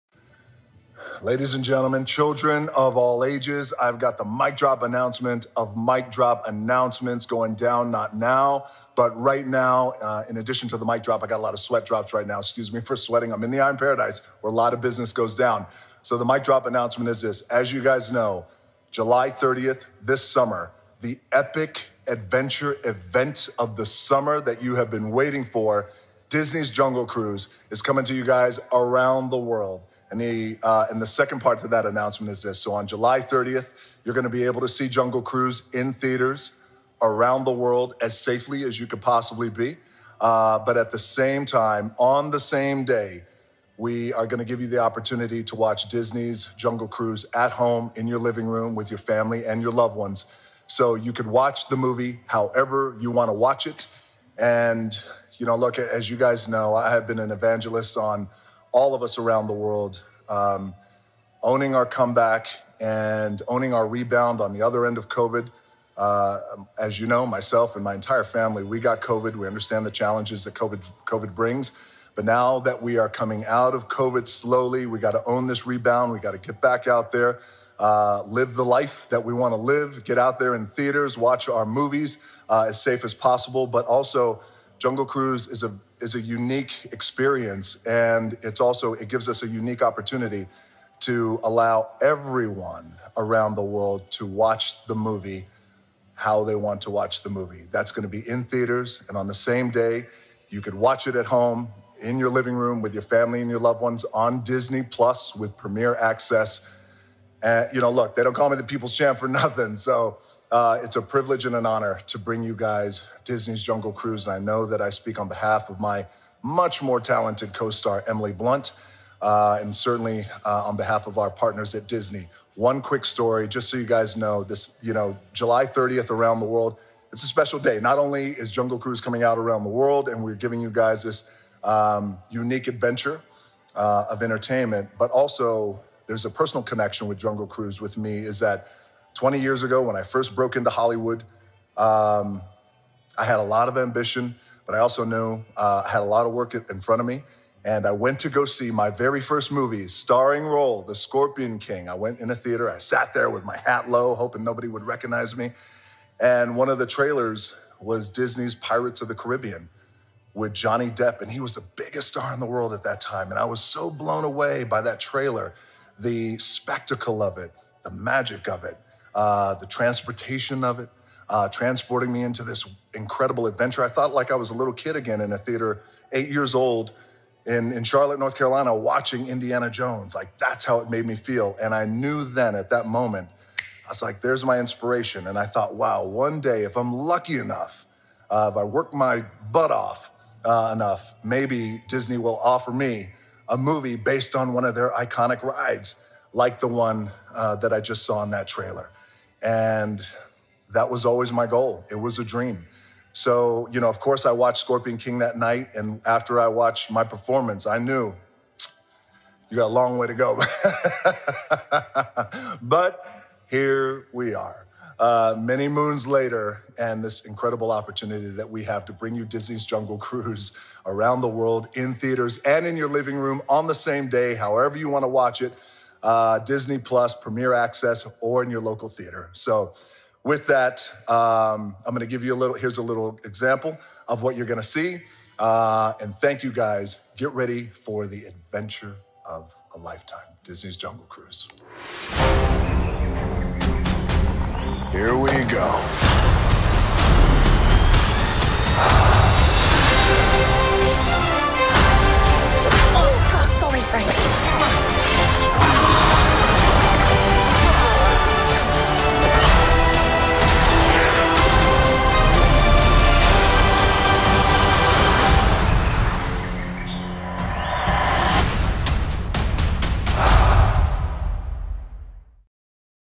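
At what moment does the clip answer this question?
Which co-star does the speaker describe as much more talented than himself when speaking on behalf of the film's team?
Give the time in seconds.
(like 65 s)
118 s.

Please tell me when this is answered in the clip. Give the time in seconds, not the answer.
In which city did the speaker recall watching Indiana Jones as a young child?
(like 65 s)
177 s.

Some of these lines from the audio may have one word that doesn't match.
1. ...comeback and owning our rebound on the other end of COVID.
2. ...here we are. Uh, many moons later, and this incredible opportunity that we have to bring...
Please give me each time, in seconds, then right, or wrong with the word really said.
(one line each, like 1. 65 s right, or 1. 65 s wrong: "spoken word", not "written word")
1. 61 s right
2. 213 s right.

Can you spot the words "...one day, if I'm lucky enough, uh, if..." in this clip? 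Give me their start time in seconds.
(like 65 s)
186 s.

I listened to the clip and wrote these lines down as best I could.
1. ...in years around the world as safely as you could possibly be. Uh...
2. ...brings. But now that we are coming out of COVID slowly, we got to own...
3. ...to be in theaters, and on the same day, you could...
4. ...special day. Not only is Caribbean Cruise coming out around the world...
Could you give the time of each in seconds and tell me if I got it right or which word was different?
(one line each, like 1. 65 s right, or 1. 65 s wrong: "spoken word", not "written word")
1. 35 s wrong: "theaters", not "years"
2. 71 s right
3. 98 s right
4. 127 s wrong: "Jungle", not "Caribbean".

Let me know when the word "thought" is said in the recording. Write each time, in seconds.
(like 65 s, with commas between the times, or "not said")
173 s, 185 s.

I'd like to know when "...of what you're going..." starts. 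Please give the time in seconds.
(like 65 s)
234 s.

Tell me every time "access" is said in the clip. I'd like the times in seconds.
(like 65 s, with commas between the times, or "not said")
105 s, 227 s.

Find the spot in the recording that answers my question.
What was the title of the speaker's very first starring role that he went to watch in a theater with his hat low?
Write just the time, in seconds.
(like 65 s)
150 s.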